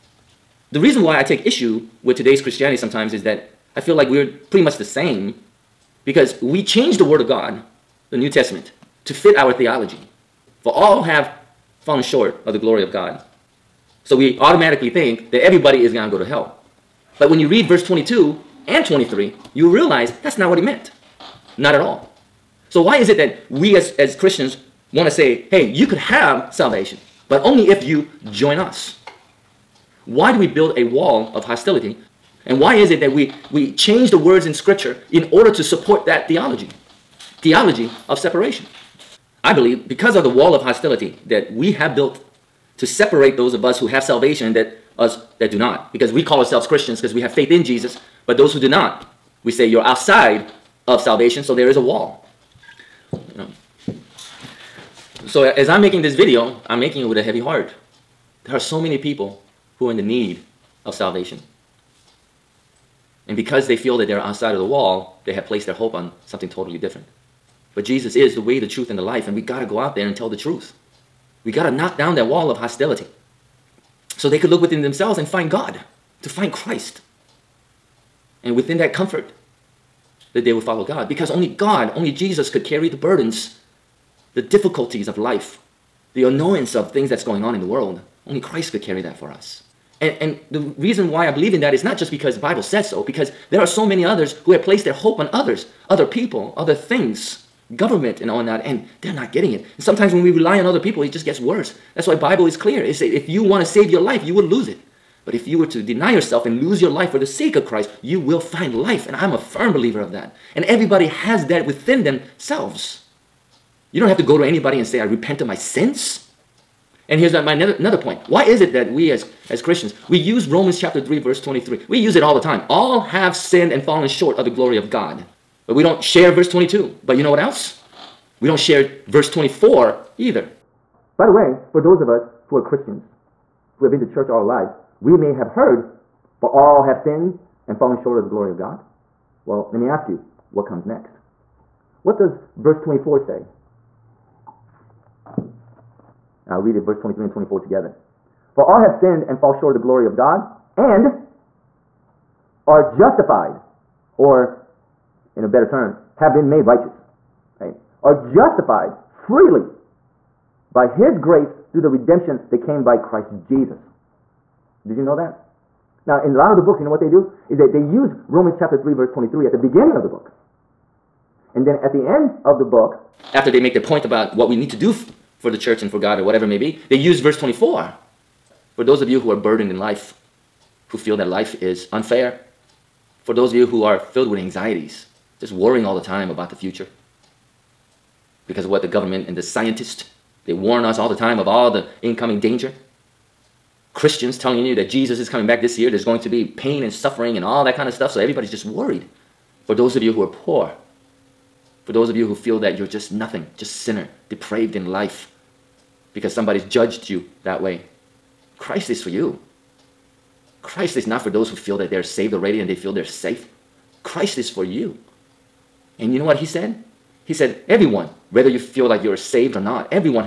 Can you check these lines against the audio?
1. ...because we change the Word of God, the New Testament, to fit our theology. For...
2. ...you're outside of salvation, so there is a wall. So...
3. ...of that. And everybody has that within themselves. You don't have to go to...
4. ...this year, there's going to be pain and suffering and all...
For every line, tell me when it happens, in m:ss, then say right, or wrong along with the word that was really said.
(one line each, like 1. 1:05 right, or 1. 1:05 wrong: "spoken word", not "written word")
1. 0:06 right
2. 0:49 right
3. 1:49 right
4. 3:15 right.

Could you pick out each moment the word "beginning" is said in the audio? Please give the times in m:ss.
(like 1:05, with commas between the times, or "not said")
2:49.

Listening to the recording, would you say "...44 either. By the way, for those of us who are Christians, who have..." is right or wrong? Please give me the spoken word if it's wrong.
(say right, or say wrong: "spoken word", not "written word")
wrong: "24", not "44".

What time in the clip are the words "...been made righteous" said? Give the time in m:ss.
2:36.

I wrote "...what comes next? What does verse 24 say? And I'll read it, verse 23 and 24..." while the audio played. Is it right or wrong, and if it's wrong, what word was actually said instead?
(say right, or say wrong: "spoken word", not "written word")
right.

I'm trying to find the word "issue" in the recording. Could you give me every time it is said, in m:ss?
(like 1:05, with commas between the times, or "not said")
0:01.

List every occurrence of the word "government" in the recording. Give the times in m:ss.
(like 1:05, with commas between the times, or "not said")
1:37, 3:08.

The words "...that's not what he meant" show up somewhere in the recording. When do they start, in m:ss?
0:20.